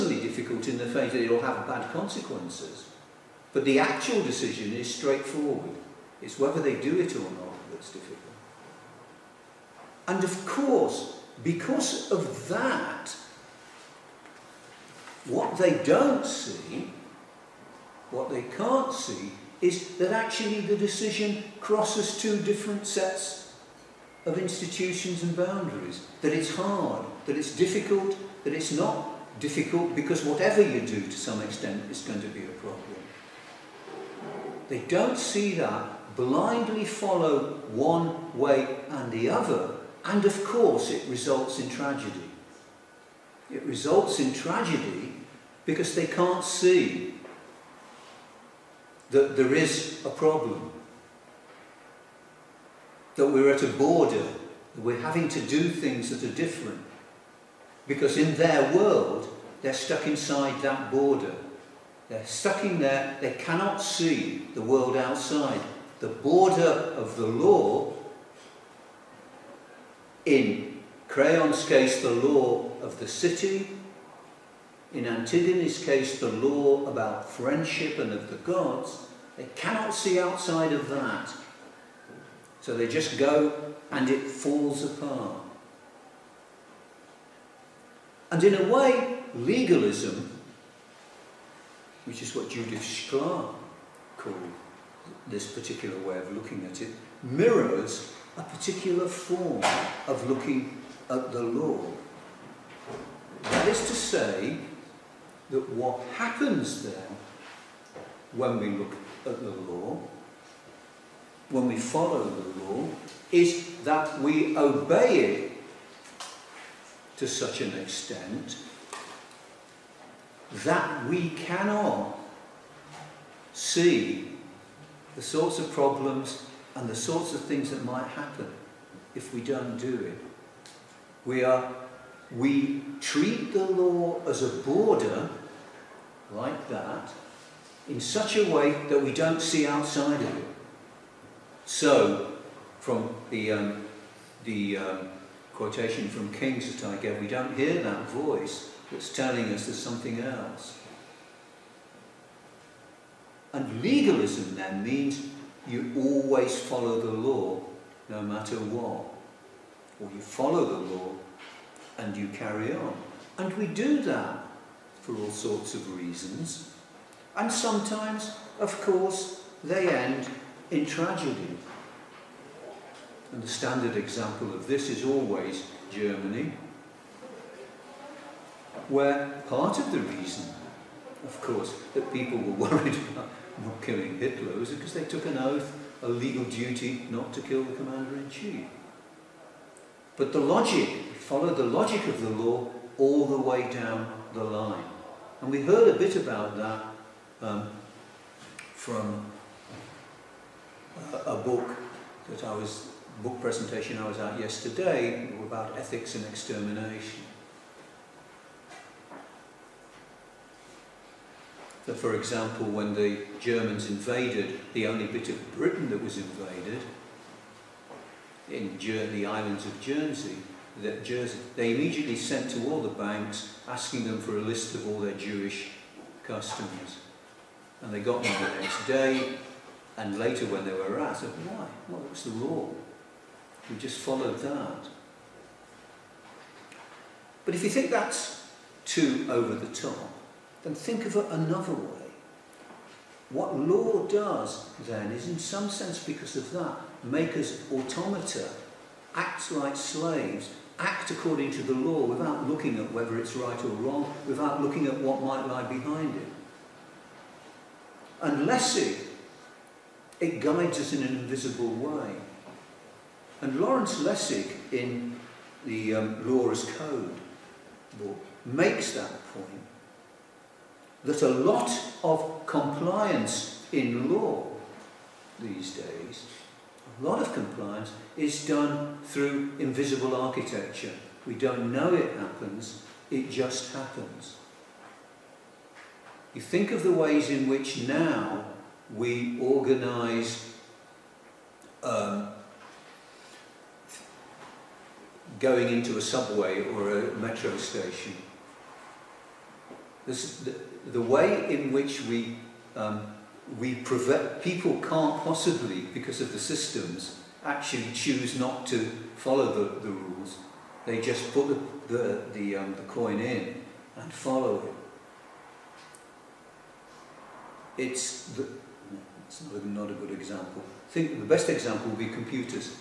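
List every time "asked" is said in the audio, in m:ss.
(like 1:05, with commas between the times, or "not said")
3:51.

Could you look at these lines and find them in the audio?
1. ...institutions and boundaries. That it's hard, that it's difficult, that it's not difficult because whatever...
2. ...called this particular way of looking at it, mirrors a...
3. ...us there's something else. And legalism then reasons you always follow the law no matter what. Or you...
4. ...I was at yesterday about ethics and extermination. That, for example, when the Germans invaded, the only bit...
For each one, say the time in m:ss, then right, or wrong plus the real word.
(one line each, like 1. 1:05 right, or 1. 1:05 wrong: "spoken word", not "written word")
1. 0:24 right
2. 1:34 right
3. 2:29 wrong: "means", not "reasons"
4. 3:23 right.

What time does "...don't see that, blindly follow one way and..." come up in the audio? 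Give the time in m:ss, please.
0:34.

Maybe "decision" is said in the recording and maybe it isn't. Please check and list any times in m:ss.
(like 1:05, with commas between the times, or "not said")
0:04, 0:20.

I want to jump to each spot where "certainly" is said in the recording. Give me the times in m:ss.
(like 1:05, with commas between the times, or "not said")
not said.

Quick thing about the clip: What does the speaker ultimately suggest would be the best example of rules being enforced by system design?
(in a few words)
Computers.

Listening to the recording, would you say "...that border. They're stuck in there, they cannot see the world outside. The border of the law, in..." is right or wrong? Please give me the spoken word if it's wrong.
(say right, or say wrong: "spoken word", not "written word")
right.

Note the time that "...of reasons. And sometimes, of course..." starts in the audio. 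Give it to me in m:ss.
2:45.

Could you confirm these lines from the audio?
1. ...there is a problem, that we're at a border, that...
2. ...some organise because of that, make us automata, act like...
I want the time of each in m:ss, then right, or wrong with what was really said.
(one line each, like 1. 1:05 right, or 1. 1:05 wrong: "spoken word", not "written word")
1. 0:49 right
2. 4:05 wrong: "sense", not "organise".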